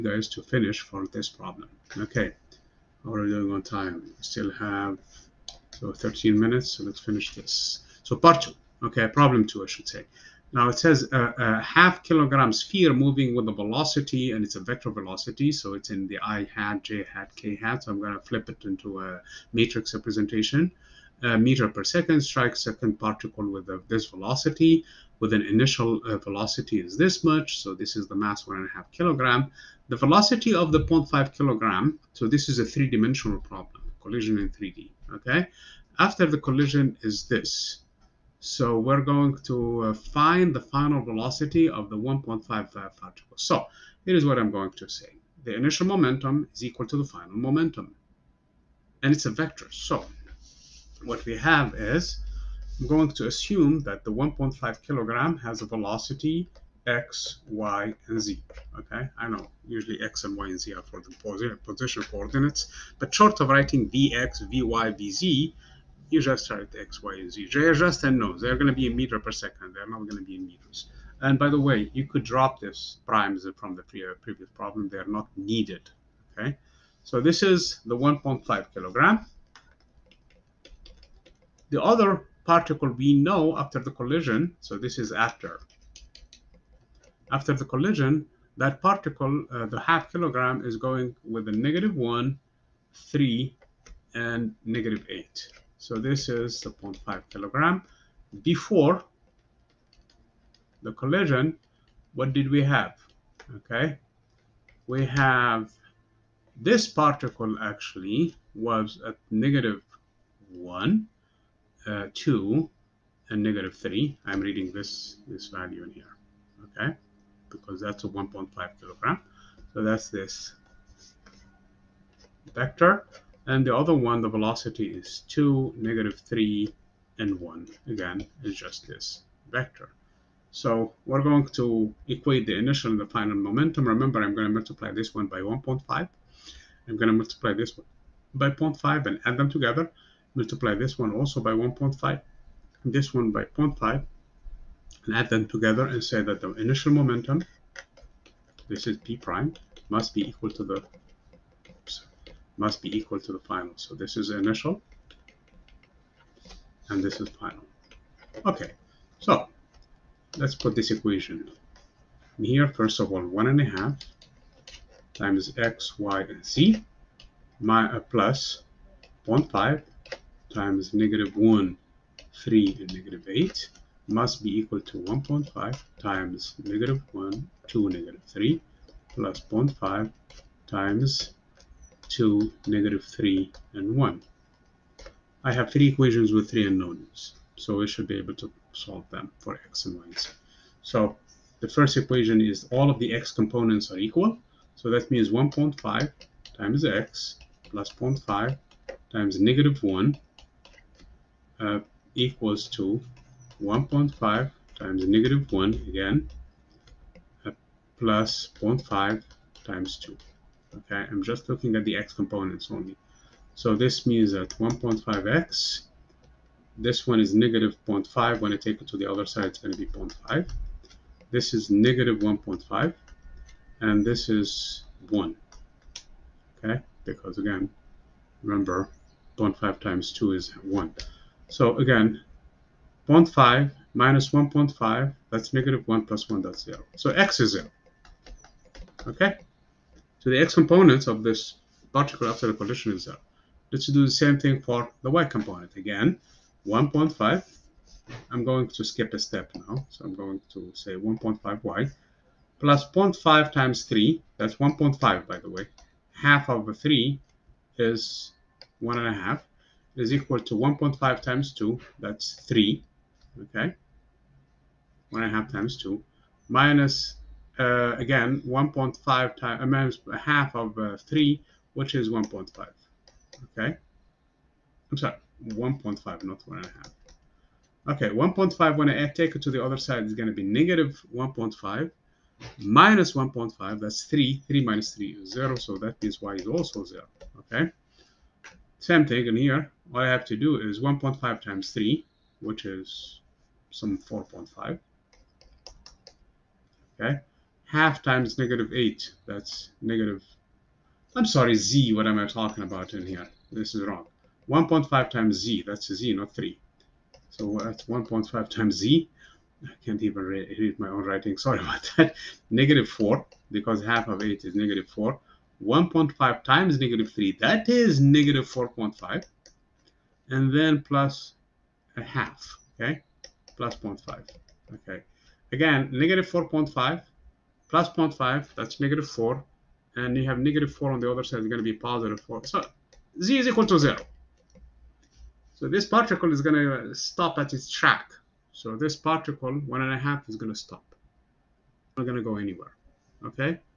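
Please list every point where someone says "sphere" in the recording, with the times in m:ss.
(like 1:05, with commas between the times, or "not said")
0:12.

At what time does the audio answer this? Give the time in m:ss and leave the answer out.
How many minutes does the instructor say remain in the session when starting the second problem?
0:05.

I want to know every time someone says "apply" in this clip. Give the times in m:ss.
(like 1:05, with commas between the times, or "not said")
not said.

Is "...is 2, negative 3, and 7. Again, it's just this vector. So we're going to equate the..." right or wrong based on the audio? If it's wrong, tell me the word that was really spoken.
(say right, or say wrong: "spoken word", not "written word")
wrong: "1", not "7".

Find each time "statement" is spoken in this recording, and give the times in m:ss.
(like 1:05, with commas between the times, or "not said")
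not said.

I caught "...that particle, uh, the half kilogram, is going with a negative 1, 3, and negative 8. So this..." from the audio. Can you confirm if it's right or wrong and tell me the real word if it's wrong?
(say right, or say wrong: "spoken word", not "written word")
right.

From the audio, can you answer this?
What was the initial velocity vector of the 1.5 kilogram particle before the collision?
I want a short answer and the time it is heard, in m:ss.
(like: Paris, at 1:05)
-1, 2, -3, at 1:49.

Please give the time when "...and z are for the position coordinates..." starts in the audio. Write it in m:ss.
1:00.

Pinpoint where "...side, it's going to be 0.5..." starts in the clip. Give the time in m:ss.
3:39.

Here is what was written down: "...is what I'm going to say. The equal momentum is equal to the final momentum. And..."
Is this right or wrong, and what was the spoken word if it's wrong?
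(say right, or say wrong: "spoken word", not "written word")
wrong: "initial", not "equal".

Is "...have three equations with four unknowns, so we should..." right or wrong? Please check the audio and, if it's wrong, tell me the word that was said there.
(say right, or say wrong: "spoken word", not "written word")
wrong: "three", not "four".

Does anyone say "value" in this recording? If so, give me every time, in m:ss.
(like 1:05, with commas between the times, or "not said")
1:55.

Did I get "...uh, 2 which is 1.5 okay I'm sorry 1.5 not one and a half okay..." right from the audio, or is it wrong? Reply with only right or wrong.
wrong.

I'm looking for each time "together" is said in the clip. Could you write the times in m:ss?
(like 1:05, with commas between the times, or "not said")
2:19, 2:25.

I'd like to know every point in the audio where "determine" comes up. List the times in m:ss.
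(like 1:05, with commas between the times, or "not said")
not said.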